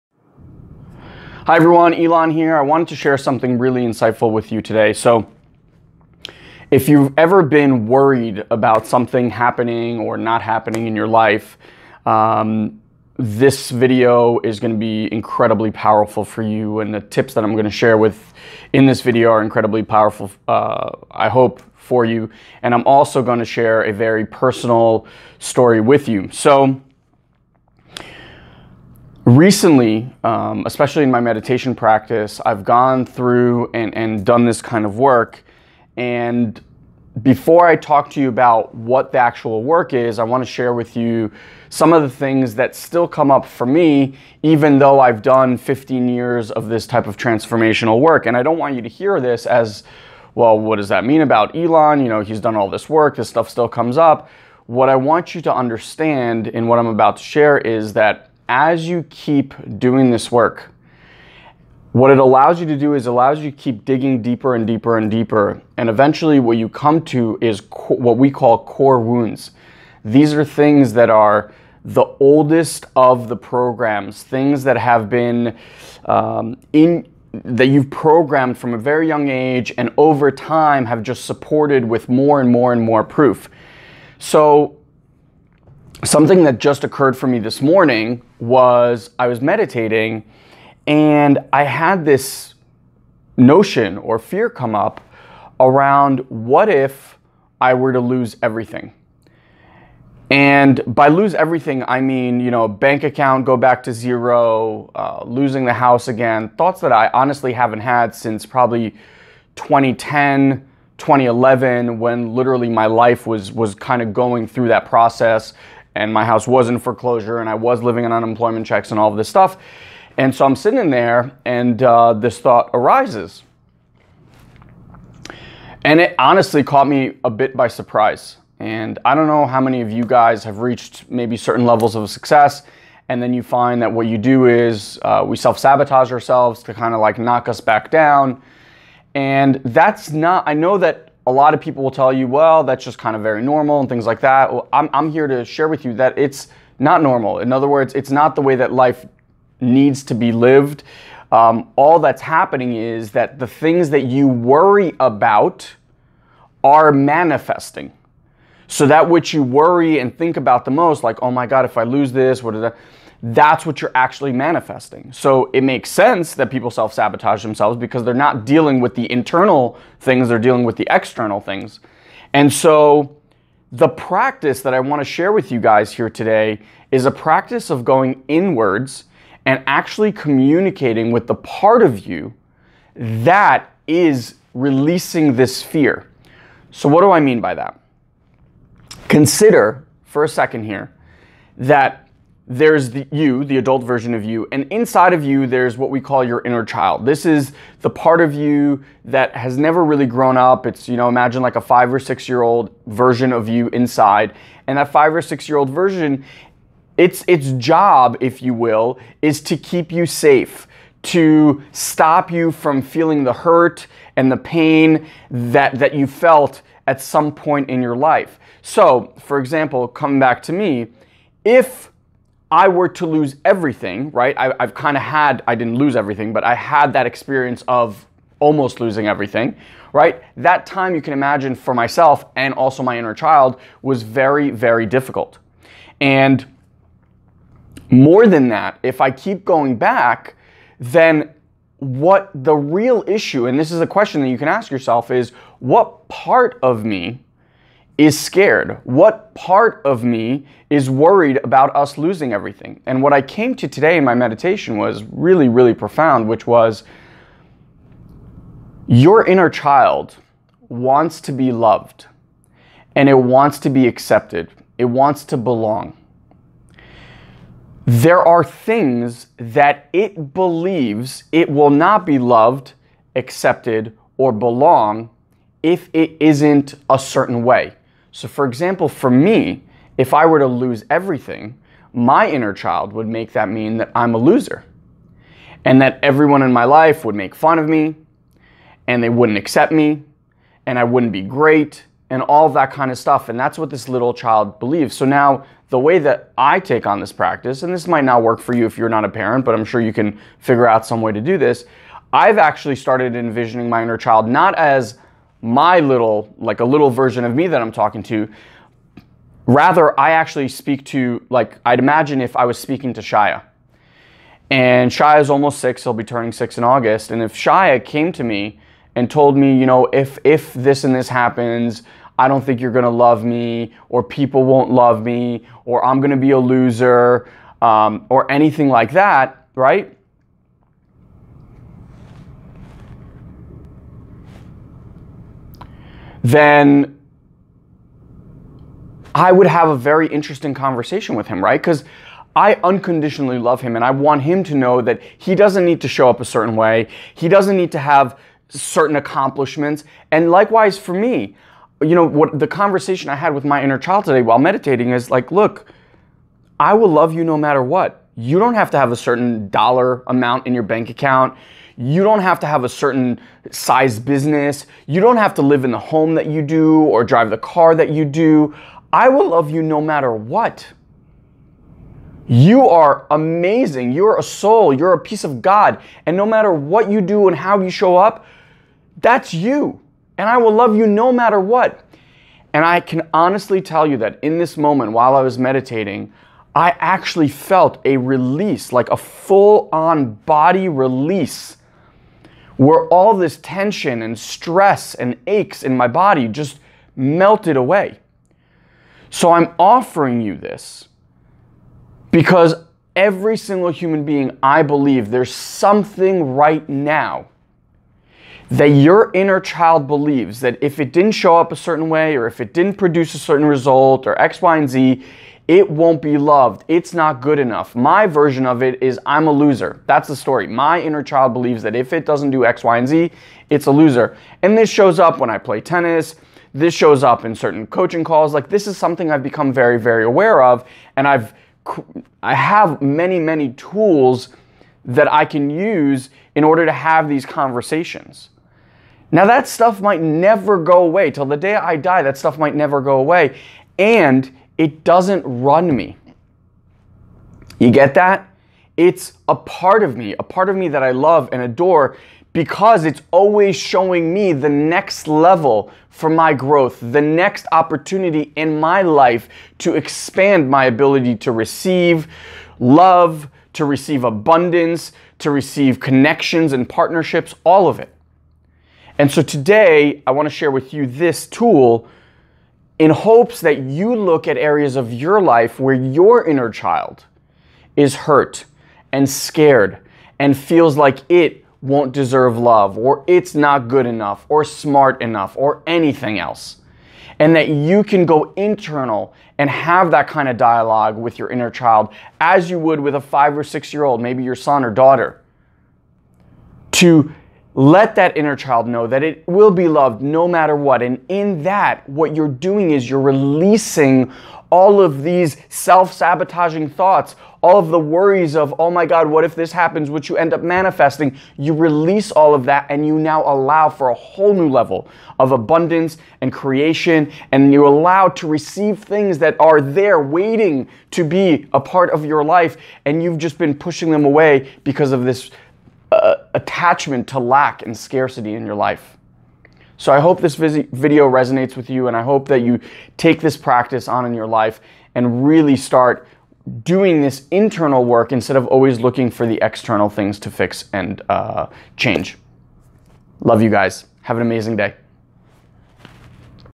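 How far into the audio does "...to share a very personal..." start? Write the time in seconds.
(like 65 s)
23 s.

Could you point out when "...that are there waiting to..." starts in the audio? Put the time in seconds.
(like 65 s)
519 s.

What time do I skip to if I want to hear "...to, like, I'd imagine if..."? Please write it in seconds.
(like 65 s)
310 s.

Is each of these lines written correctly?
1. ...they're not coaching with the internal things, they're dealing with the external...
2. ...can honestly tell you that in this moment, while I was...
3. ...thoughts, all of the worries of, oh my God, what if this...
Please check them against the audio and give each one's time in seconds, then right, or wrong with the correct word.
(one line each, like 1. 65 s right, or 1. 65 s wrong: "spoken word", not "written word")
1. 168 s wrong: "dealing", not "coaching"
2. 382 s right
3. 506 s right.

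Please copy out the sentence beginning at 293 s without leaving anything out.
And that's what this little child believes.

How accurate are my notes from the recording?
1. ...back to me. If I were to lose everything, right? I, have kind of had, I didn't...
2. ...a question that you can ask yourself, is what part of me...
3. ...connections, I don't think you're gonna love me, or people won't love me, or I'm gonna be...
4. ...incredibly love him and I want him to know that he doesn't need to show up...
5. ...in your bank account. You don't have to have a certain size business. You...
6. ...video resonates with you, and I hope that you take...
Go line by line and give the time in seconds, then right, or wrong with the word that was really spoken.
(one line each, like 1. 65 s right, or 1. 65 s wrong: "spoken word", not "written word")
1. 220 s right
2. 243 s right
3. 321 s wrong: "happens", not "connections"
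4. 342 s wrong: "unconditionally", not "incredibly"
5. 360 s right
6. 530 s right.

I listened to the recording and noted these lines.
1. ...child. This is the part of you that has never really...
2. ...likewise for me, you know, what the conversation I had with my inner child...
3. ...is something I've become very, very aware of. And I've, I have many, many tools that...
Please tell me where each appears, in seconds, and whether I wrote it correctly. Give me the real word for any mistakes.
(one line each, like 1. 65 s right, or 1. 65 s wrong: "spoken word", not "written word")
1. 196 s right
2. 350 s right
3. 428 s right.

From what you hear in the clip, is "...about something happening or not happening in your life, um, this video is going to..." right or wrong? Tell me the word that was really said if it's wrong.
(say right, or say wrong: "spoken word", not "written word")
right.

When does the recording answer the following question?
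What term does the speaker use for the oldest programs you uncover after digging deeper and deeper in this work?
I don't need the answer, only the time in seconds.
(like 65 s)
68 s.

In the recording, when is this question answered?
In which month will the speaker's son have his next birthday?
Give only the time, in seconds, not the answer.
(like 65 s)
316 s.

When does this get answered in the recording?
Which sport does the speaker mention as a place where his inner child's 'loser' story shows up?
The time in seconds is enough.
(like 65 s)
425 s.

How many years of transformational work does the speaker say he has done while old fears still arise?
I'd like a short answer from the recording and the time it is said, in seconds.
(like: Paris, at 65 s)
15, at 45 s.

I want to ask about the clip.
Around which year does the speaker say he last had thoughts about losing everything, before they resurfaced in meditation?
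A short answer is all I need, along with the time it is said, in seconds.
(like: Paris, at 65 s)
2010, at 109 s.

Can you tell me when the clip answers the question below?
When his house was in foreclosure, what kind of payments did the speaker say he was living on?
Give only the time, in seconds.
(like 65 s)
118 s.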